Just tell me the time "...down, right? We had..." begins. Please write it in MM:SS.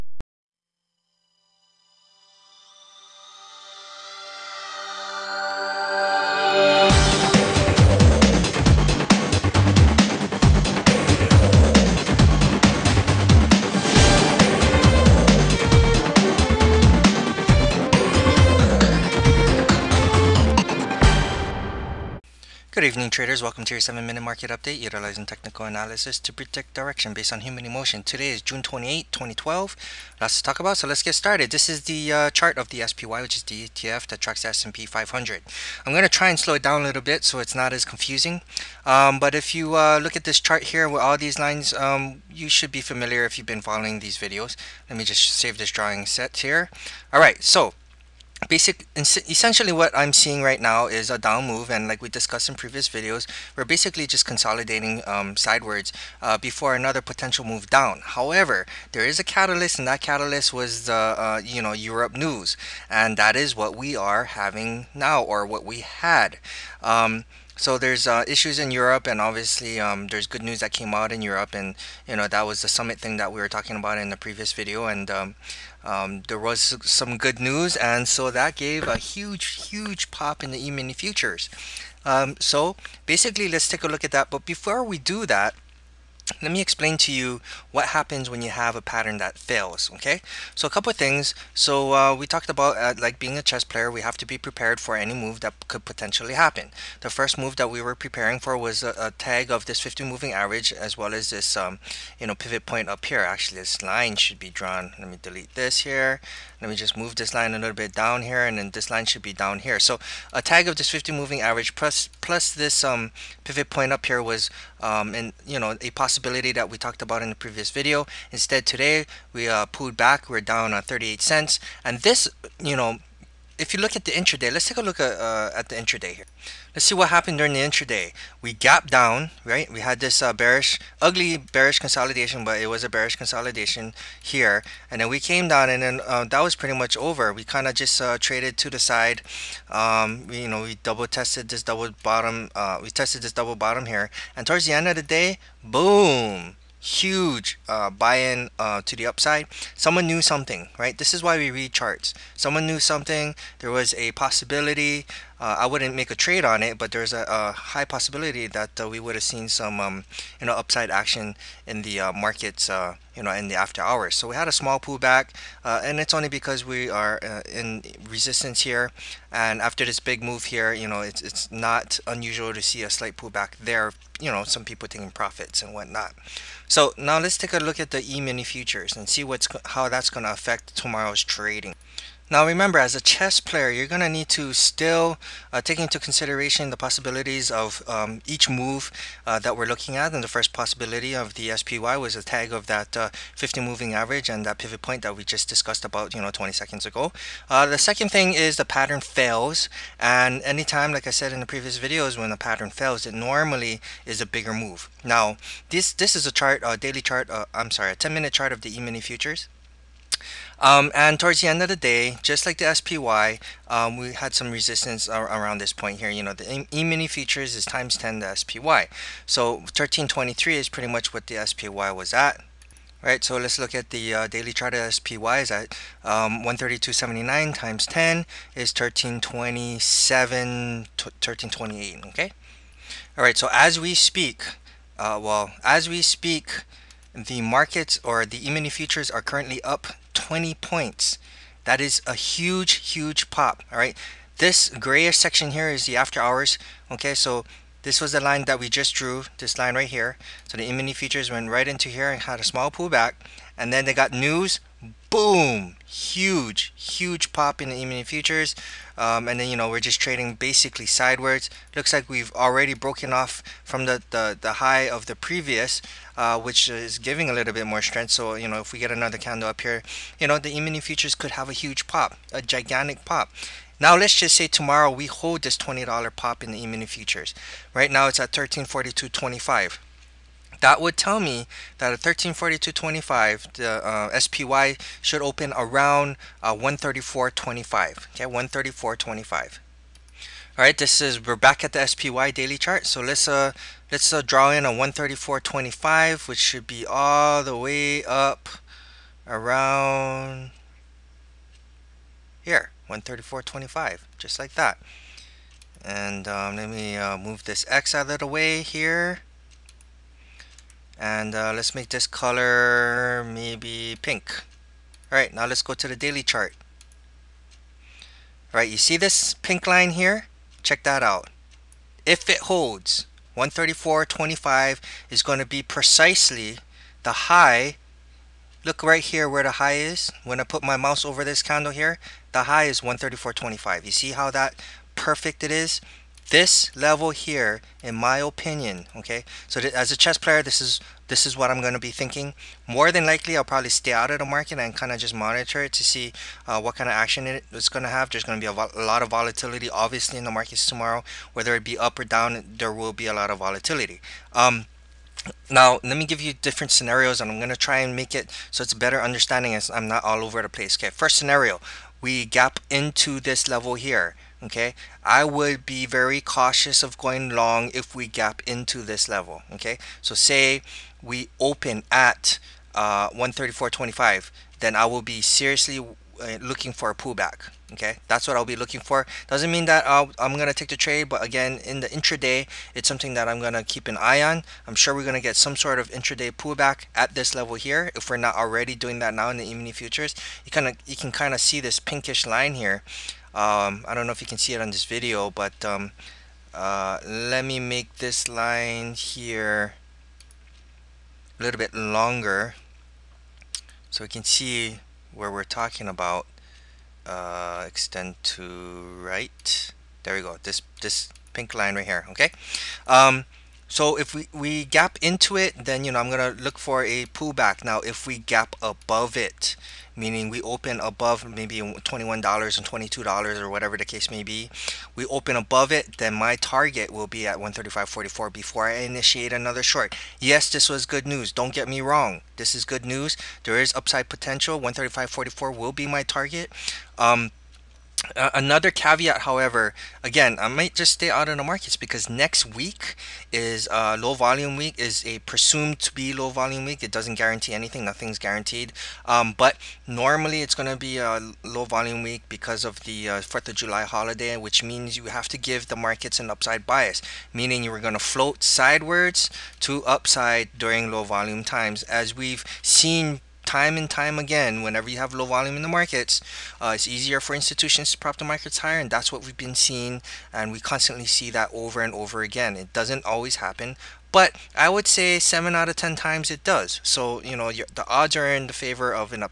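02:08.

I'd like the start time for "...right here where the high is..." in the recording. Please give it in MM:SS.
05:28.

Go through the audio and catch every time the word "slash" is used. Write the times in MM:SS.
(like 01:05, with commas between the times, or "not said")
not said.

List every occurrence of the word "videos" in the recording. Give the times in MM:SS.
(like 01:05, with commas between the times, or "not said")
00:44, 00:52, 01:14, 01:57, 03:21, 06:34.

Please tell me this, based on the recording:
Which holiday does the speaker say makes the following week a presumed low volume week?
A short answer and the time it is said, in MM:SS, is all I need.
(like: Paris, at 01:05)
4th of July, at 07:33.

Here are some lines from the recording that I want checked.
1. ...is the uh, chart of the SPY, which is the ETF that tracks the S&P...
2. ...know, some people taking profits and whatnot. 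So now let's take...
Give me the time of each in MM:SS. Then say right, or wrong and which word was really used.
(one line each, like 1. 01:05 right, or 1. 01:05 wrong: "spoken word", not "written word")
1. 00:31 right
2. 02:54 right.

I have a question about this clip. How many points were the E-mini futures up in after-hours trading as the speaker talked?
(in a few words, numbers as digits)
20 points.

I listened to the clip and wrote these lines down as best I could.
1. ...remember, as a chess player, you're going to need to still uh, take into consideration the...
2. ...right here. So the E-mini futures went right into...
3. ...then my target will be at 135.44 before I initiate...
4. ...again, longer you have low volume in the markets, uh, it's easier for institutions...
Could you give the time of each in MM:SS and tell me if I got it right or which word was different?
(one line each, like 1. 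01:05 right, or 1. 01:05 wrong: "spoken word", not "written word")
1. 03:02 right
2. 04:09 right
3. 07:05 right
4. 07:44 wrong: "whenever", not "longer".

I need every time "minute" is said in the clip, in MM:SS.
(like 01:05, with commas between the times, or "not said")
00:24, 03:28.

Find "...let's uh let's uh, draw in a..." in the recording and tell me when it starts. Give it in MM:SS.
04:52.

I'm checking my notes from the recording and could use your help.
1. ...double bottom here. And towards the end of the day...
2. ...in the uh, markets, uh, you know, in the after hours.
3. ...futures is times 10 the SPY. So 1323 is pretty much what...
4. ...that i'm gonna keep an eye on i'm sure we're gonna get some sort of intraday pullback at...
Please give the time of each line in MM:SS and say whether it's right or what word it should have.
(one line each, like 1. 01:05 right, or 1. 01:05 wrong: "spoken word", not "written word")
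1. 02:23 right
2. 02:41 right
3. 03:37 right
4. 06:23 right.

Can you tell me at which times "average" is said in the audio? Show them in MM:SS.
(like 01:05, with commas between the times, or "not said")
01:40, 01:51, 03:13.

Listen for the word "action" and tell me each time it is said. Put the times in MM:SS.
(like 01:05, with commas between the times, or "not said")
02:40, 05:46.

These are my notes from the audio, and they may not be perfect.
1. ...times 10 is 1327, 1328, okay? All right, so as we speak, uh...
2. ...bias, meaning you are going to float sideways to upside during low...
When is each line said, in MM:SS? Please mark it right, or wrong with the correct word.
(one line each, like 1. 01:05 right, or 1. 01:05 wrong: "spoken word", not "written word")
1. 03:47 right
2. 07:36 right.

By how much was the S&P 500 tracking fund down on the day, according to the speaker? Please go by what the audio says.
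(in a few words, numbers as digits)
38 cents.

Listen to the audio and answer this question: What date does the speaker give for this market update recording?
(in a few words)
June 28, 2012.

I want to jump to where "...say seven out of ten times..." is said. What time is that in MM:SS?
07:54.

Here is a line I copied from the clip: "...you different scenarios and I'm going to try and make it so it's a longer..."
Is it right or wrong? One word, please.
wrong.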